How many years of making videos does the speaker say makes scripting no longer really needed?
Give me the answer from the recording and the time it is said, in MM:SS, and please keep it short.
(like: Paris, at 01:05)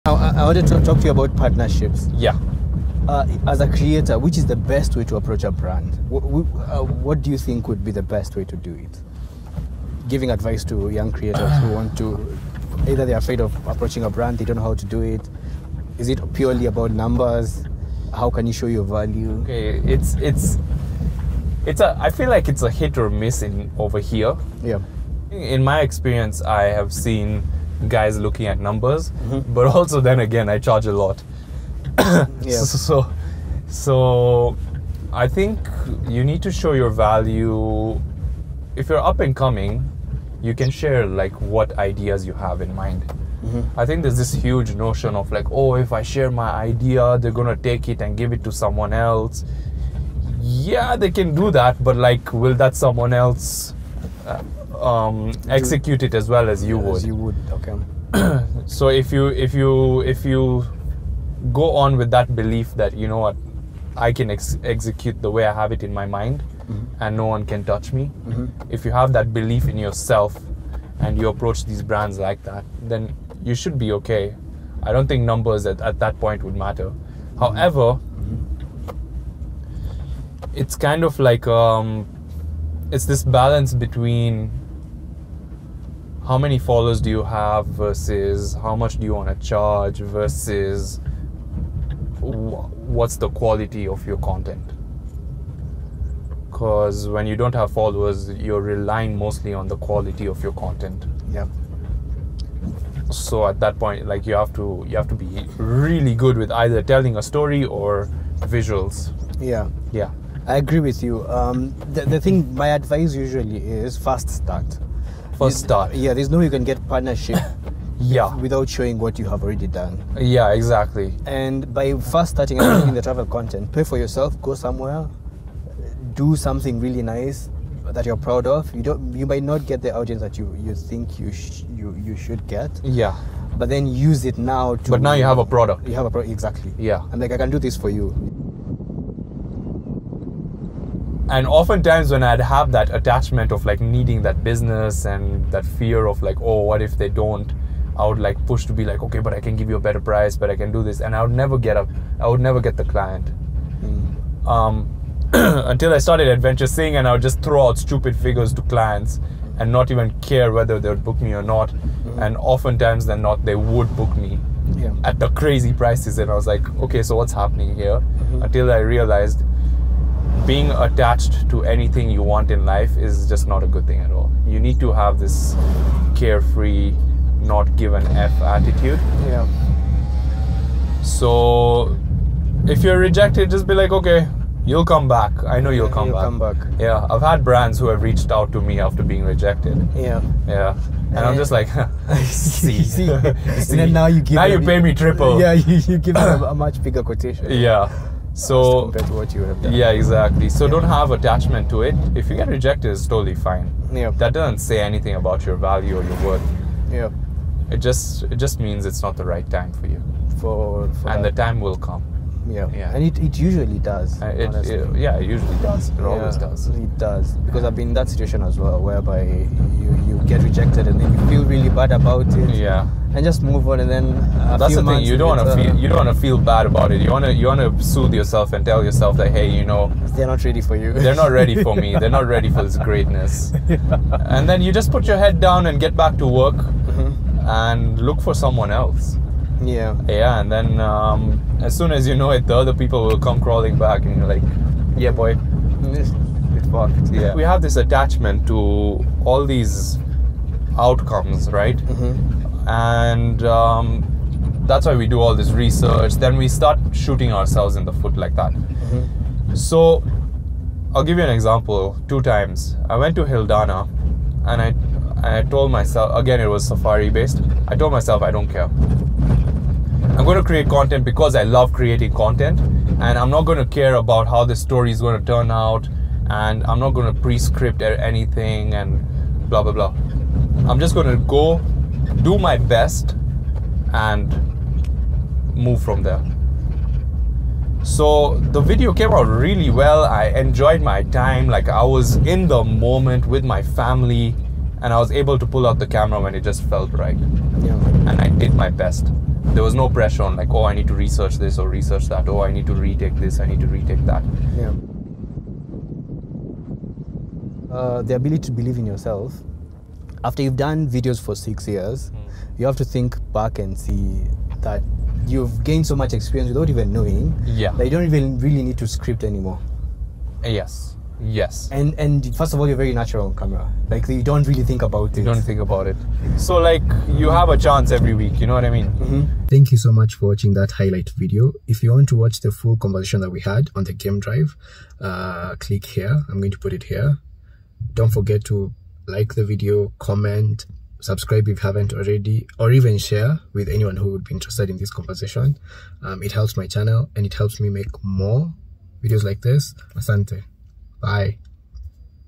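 6, at 05:11.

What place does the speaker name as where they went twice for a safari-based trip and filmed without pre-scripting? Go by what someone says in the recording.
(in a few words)
Hildana.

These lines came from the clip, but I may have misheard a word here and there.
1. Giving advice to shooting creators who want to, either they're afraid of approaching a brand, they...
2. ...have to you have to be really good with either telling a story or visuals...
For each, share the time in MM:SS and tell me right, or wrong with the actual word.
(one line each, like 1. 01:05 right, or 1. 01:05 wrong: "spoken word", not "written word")
1. 00:10 wrong: "young", not "shooting"
2. 01:44 right.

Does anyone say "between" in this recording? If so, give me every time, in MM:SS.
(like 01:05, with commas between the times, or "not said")
01:23.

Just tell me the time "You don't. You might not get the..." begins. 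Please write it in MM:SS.
02:08.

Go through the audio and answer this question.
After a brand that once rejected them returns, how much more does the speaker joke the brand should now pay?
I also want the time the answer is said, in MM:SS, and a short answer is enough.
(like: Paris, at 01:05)
triple, at 03:14.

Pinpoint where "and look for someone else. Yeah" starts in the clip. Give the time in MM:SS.
03:57.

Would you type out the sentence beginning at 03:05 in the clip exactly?
I know you'll, come, you'll back.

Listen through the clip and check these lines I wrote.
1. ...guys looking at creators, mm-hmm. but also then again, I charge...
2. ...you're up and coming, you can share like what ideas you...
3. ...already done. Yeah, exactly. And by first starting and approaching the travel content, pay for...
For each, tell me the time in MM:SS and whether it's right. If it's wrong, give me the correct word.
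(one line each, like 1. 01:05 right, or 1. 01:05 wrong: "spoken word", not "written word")
1. 00:27 wrong: "numbers", not "creators"
2. 00:38 right
3. 01:59 wrong: "making", not "approaching".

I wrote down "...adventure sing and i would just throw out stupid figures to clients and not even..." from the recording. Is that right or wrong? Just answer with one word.
right.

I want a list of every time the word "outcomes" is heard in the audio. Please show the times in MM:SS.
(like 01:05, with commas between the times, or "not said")
04:10.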